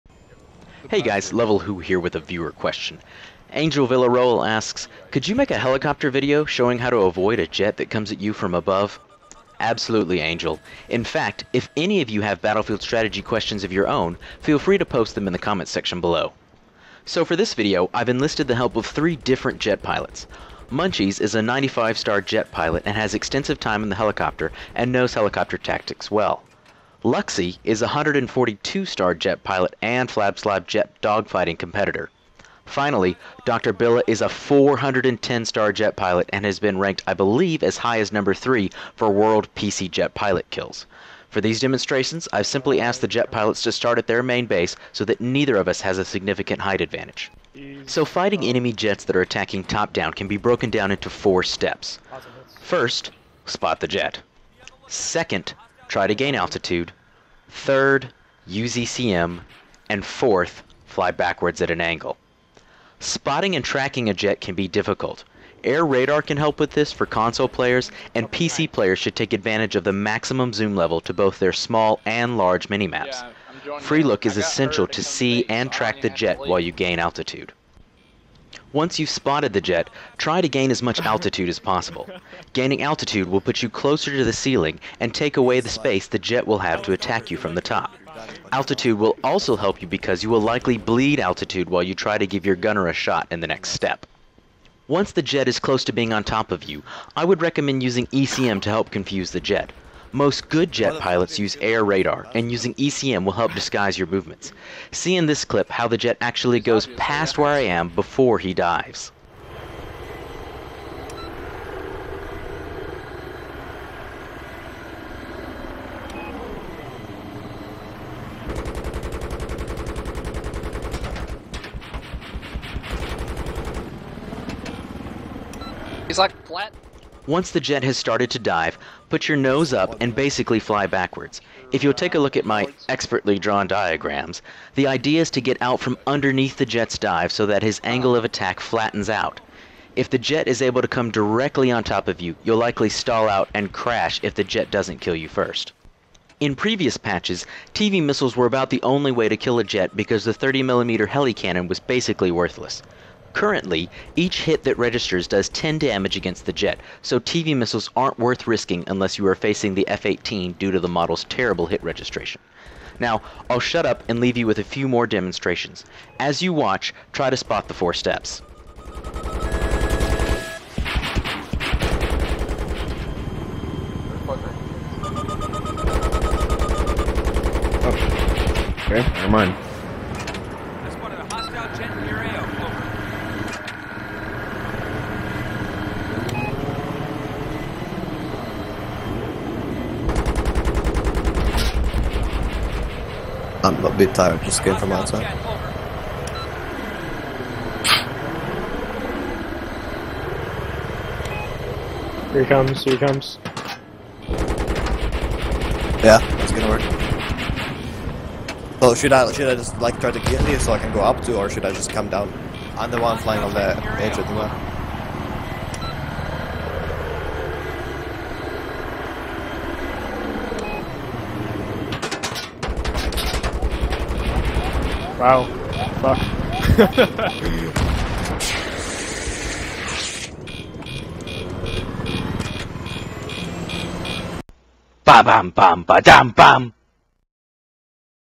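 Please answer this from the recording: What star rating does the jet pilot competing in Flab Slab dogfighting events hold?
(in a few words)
142.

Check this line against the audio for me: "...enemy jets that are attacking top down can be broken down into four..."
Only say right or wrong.
right.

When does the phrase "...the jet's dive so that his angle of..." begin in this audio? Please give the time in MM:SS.
02:16.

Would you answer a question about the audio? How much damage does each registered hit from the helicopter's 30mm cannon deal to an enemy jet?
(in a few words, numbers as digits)
10.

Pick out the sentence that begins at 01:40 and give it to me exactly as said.
Most good jet pilots use air radar, and using ECM will help disguise your movements.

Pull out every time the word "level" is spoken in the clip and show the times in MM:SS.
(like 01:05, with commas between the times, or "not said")
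00:01, 01:10.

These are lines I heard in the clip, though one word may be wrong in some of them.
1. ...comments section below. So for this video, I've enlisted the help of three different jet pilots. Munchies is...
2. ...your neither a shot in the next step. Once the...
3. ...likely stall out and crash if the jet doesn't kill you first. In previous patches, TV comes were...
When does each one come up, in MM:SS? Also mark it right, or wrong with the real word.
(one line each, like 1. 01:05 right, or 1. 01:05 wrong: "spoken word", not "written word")
1. 00:15 right
2. 01:32 wrong: "gunner", not "neither"
3. 02:22 wrong: "missiles", not "comes".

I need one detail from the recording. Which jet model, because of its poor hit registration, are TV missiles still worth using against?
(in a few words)
F-18.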